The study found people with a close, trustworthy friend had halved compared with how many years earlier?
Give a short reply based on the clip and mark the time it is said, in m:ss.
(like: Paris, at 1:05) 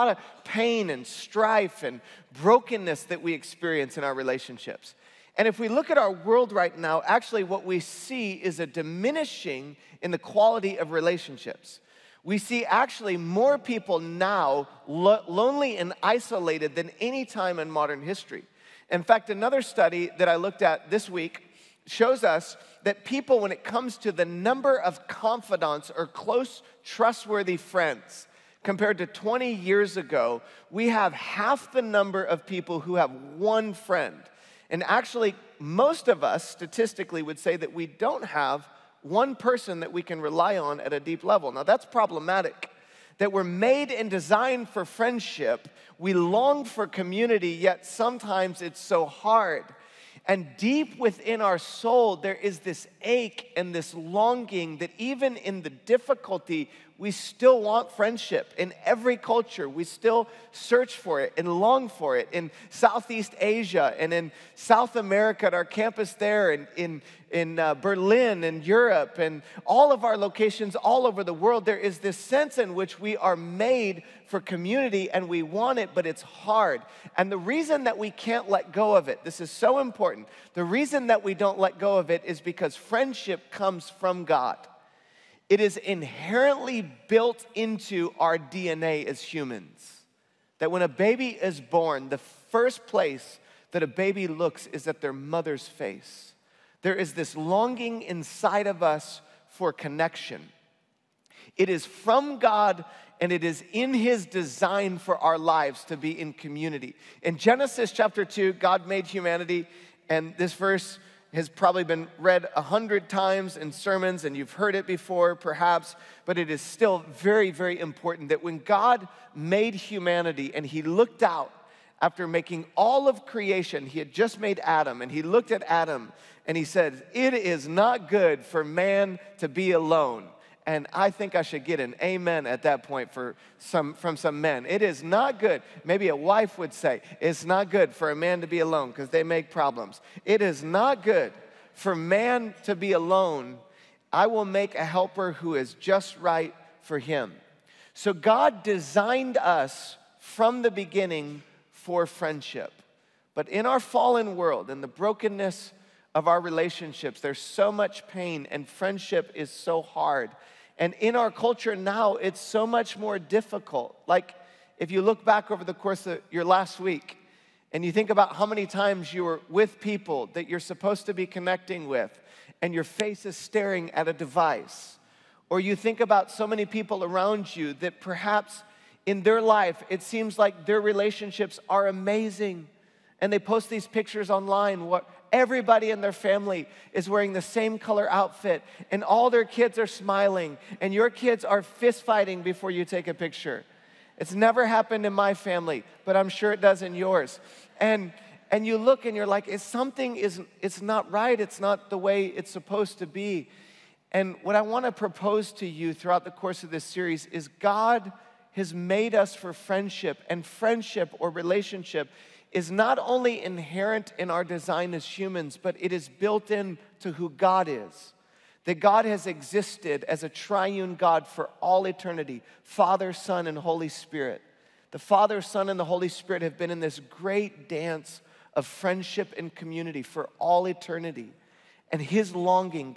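20, at 0:29.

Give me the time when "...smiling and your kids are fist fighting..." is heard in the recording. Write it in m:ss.
3:09.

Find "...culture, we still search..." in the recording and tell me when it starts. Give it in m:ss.
0:59.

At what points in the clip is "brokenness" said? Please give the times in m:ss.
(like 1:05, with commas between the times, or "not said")
0:02, 2:34.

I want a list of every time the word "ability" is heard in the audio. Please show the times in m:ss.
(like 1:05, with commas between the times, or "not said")
not said.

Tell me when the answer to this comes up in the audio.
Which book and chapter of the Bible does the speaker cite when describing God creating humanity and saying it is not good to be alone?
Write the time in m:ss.
1:47.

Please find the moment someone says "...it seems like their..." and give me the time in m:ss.
2:59.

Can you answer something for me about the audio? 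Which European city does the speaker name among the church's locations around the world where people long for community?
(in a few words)
Berlin.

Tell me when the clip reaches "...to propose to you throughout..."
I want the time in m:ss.
3:24.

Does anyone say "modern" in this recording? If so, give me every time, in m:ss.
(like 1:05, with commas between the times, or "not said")
0:17.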